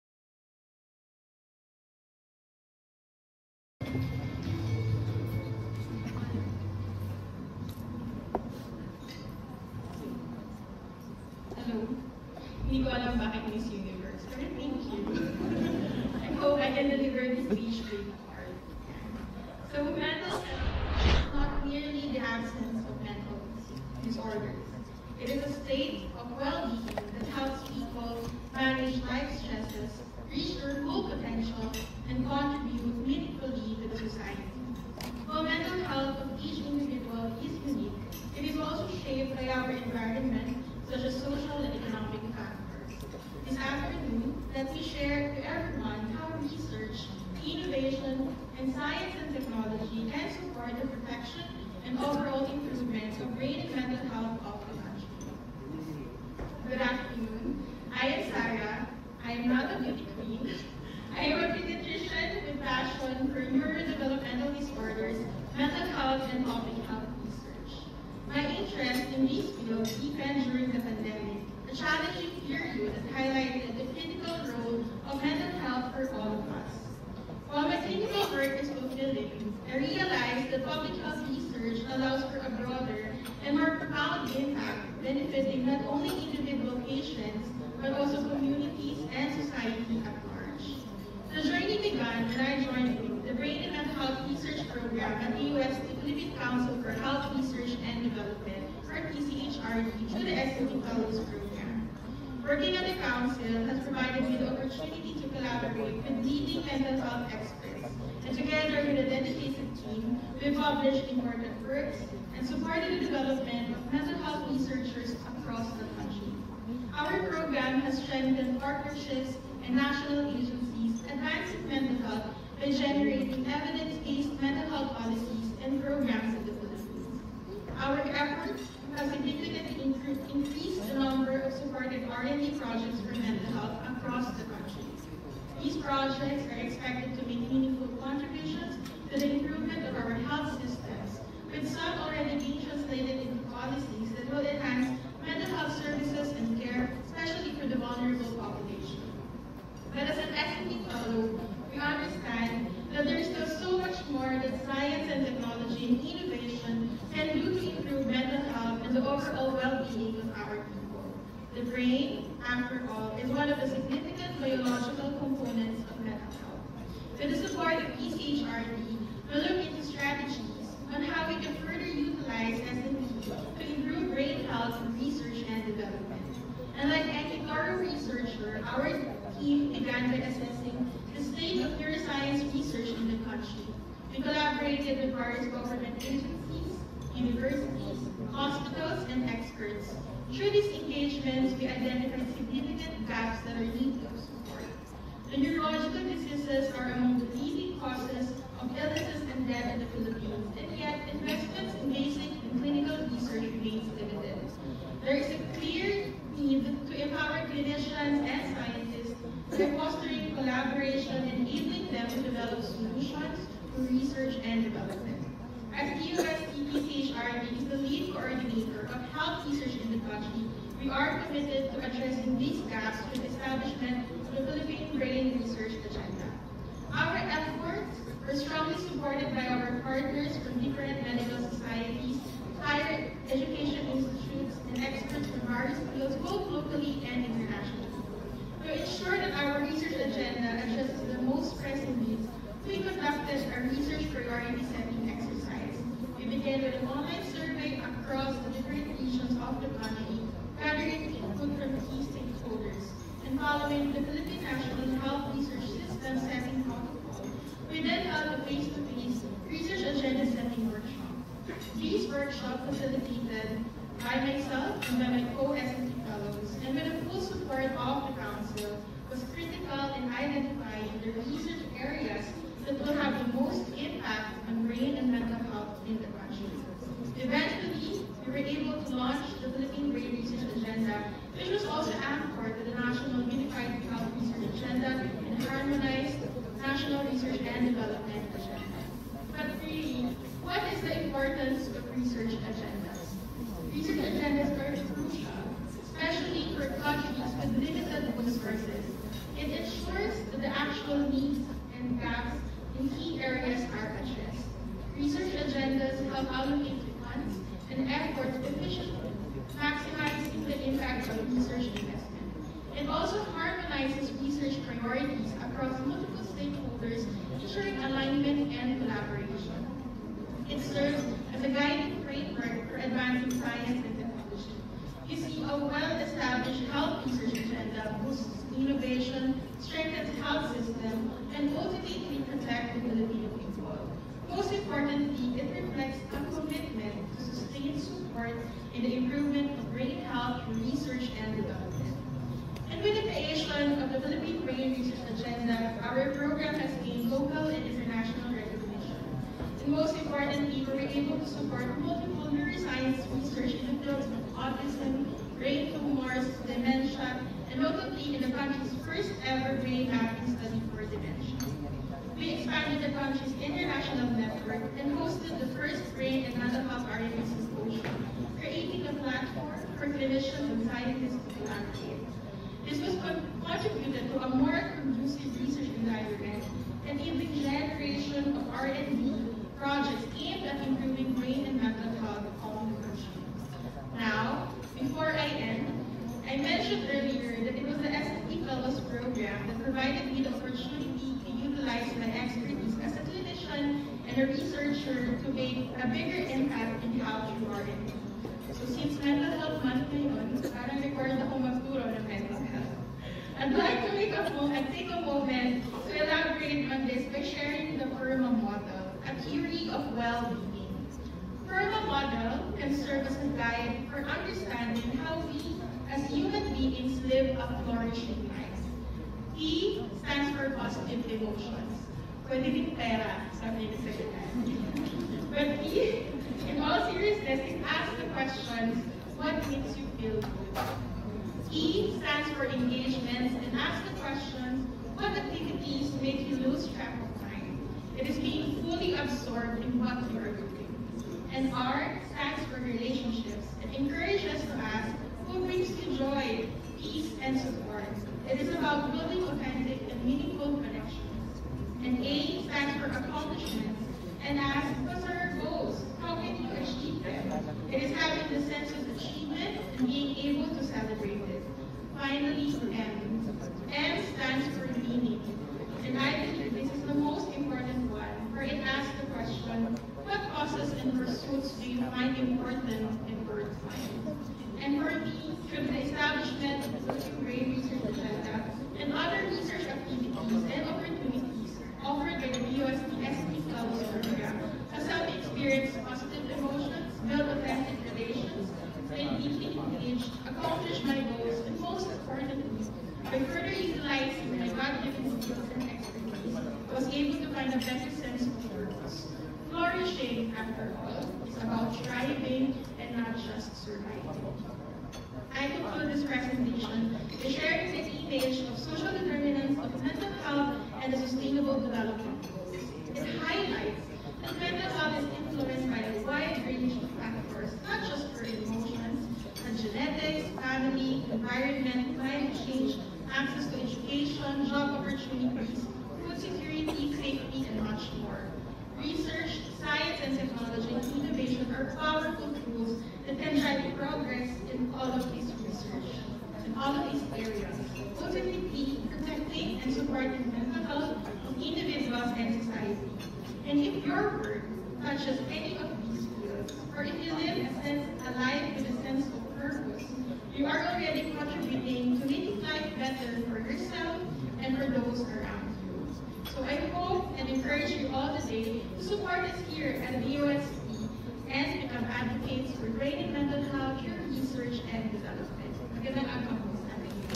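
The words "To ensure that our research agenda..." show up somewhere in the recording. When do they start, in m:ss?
3:58.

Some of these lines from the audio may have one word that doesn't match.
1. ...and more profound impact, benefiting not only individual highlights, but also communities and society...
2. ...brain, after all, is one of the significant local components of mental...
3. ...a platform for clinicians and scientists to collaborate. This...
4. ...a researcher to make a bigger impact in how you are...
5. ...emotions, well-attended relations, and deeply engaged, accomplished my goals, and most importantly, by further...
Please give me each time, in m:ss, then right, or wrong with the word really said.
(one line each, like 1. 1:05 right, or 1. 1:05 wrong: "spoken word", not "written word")
1. 1:23 wrong: "patients", not "highlights"
2. 2:41 wrong: "biological", not "local"
3. 6:08 right
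4. 6:34 right
5. 8:06 right.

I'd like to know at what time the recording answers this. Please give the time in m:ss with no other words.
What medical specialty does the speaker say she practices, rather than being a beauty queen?
1:01.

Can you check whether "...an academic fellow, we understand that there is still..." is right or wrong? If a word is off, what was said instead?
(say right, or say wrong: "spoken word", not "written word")
right.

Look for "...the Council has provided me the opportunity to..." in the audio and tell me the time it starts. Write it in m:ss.
1:42.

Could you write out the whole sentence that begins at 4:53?
Research agendas are crucial, especially for countries with limited resources.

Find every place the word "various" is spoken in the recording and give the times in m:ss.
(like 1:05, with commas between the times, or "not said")
3:05, 3:55.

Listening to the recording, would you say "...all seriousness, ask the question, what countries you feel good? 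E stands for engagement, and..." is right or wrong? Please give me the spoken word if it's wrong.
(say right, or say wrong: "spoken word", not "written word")
wrong: "makes", not "countries".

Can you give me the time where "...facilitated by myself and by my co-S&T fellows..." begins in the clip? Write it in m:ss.
4:22.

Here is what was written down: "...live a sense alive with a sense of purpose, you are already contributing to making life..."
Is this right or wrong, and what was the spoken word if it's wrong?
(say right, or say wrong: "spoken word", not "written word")
right.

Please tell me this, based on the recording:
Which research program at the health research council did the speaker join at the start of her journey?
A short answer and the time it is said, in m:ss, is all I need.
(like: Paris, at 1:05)
Brain and Mental Health Research Program, at 1:33.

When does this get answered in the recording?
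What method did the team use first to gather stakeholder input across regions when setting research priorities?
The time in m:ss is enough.
4:06.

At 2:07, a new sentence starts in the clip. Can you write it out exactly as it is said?
Our efforts have significantly increased the number of supported R&D projects for mental health across the country.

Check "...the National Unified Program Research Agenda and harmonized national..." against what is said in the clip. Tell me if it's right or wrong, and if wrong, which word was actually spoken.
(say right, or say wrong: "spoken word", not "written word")
wrong: "Health", not "Program".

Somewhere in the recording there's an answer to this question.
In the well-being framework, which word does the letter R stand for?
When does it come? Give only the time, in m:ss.
7:22.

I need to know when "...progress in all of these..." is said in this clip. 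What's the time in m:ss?
8:53.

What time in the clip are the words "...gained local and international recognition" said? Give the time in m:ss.
5:46.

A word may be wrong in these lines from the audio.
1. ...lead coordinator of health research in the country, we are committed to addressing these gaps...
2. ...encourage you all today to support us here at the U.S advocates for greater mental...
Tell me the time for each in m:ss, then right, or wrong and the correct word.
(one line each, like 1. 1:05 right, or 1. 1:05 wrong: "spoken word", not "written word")
1. 3:37 right
2. 9:17 right.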